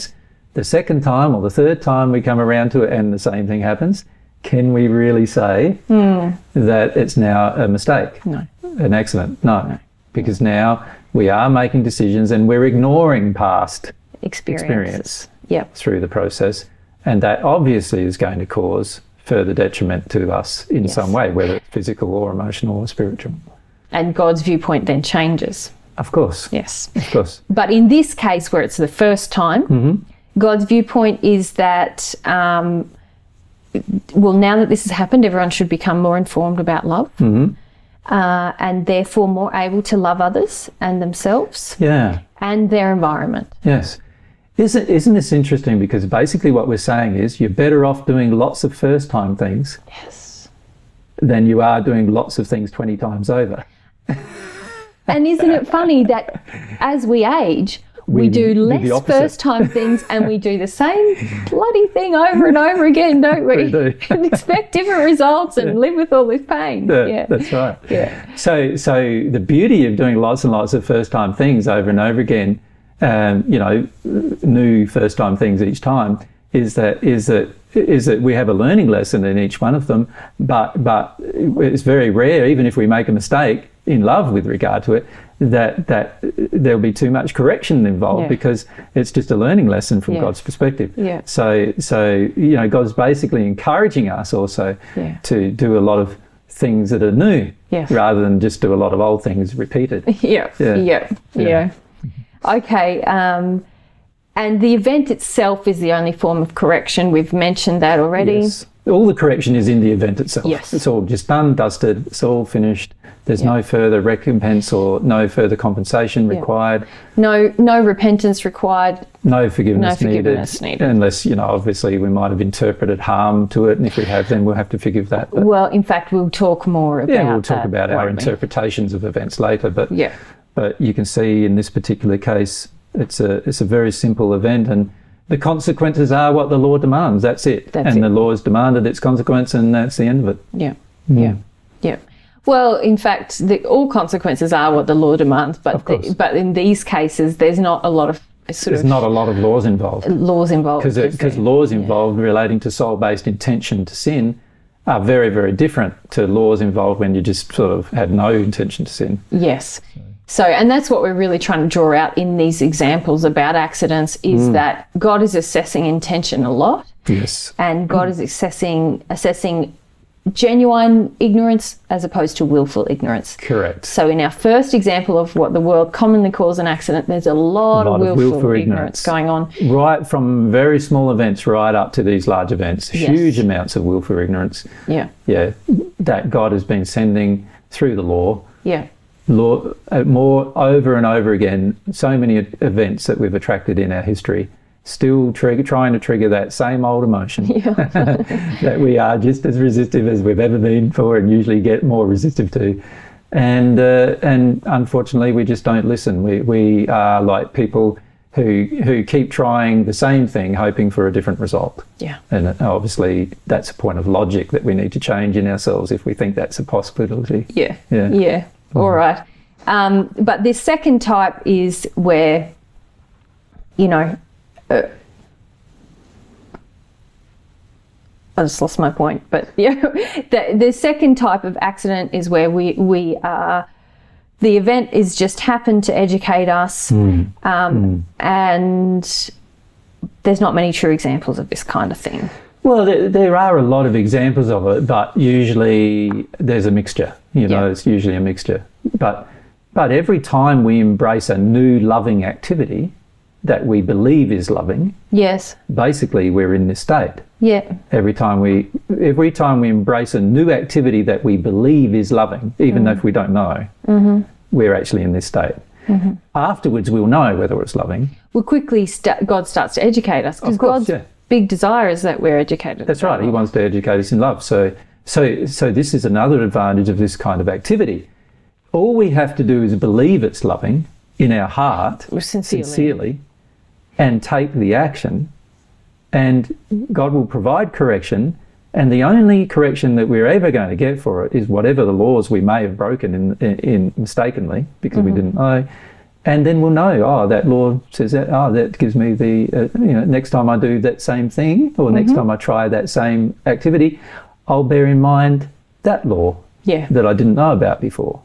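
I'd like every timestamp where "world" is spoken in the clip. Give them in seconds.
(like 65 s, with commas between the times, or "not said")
175 s.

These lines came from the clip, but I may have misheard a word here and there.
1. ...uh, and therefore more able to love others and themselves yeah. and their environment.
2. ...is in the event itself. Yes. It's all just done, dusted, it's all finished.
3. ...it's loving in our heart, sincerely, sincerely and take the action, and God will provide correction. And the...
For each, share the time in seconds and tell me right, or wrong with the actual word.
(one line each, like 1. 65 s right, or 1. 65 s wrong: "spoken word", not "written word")
1. 38 s right
2. 109 s right
3. 280 s right.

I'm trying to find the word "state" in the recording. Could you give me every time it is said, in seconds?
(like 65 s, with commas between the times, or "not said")
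256 s, 265 s.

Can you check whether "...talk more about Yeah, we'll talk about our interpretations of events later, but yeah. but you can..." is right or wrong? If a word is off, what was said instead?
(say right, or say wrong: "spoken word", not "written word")
right.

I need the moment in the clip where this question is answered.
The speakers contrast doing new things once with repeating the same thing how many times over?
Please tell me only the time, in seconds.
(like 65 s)
52 s.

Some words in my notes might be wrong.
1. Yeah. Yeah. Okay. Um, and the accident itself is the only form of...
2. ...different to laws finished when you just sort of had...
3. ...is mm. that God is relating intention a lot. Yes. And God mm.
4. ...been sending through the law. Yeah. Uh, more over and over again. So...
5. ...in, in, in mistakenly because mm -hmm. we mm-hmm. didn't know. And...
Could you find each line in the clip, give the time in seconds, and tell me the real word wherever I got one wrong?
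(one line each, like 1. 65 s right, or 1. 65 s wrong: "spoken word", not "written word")
1. 100 s wrong: "event", not "accident"
2. 155 s wrong: "involved", not "finished"
3. 164 s wrong: "assessing", not "relating"
4. 186 s right
5. 293 s right.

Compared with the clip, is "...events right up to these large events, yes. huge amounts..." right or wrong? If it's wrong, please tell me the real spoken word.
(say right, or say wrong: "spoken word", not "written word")
right.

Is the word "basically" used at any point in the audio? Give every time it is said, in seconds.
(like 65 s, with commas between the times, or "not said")
46 s, 92 s, 255 s.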